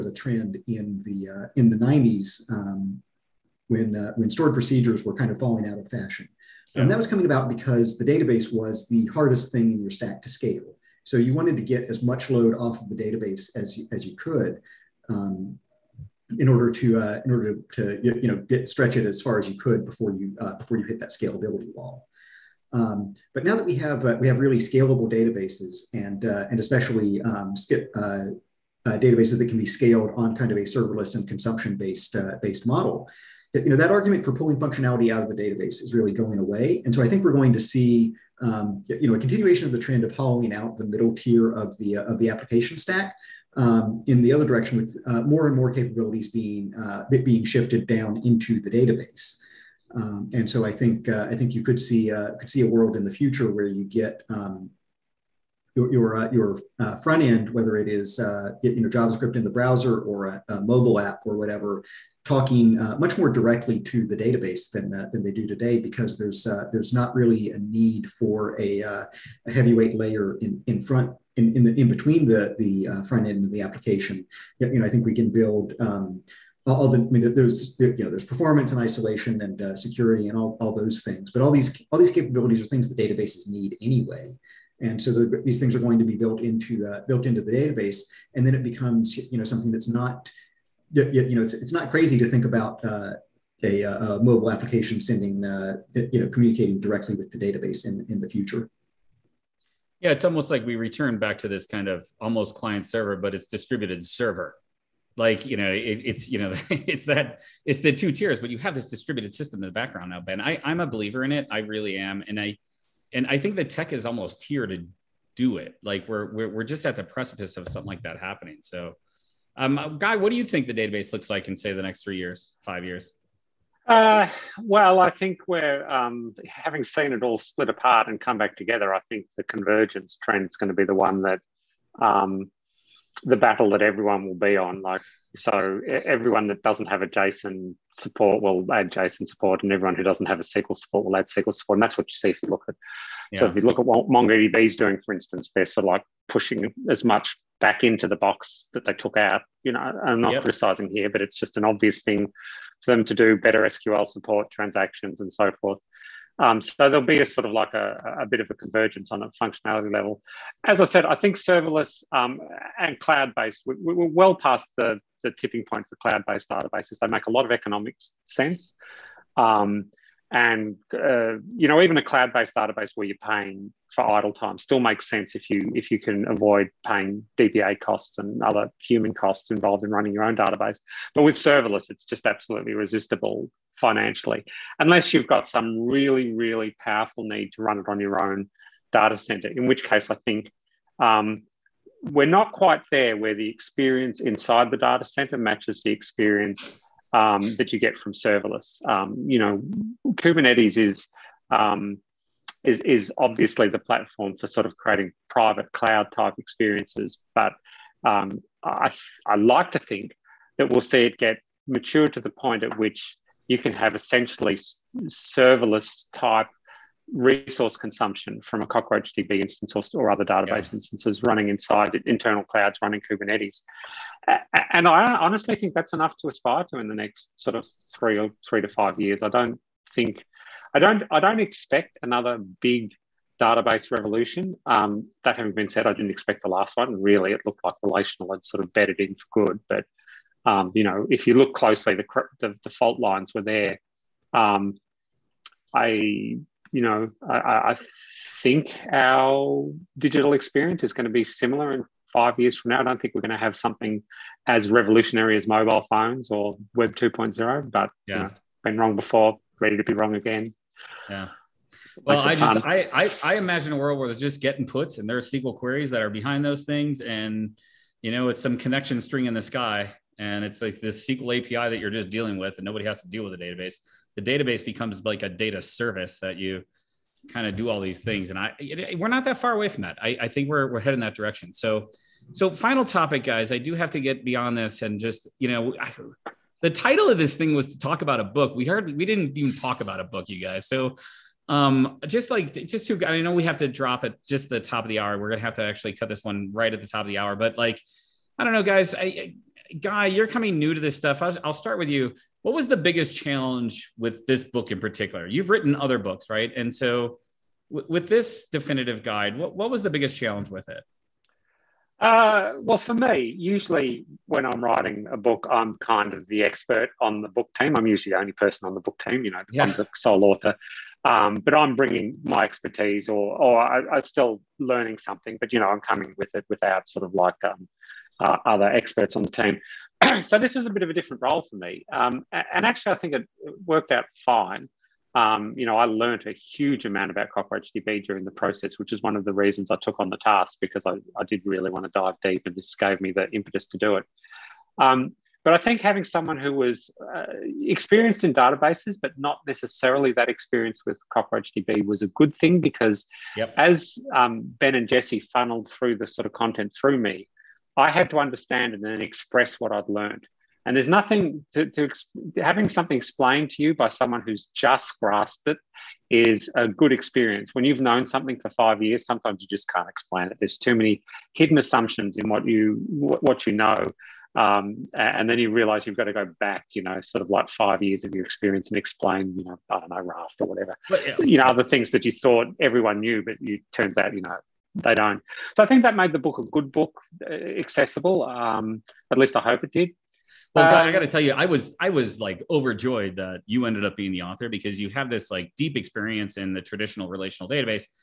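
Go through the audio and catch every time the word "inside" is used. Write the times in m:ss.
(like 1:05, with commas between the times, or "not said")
3:14, 3:41.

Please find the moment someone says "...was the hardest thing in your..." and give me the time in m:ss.
0:08.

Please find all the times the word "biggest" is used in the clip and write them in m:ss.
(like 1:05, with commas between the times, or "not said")
5:02, 5:09.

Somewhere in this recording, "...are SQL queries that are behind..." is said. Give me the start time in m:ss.
4:25.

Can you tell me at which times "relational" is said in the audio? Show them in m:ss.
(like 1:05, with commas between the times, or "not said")
3:57, 6:37.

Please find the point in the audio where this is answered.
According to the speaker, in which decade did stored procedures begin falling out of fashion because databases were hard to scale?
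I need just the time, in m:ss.
0:01.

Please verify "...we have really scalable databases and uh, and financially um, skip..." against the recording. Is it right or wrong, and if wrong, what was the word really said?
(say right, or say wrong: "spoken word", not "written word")
wrong: "especially", not "financially".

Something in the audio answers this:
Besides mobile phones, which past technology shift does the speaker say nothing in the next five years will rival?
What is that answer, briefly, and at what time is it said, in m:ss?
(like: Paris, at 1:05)
Web 2.0, at 4:16.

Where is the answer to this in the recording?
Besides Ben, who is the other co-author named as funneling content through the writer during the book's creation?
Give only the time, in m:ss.
5:54.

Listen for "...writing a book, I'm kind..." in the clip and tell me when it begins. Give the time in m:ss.
5:14.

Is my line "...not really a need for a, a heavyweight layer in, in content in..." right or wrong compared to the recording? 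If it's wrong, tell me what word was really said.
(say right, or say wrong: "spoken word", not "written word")
wrong: "front", not "content".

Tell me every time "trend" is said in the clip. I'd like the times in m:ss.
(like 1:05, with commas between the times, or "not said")
0:00, 0:39, 2:10.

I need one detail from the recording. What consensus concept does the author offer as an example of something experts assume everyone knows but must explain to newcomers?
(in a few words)
Raft.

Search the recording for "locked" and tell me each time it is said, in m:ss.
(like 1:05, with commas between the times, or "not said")
not said.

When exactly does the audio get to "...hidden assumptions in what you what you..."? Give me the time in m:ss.
6:11.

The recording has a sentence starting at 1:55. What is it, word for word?
Like we're we're, we're just at the precipice of something like that happening.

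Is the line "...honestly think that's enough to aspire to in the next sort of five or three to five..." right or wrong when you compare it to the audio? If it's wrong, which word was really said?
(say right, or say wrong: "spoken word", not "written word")
wrong: "three", not "five".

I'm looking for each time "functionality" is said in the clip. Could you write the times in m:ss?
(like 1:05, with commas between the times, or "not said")
0:34, 2:39.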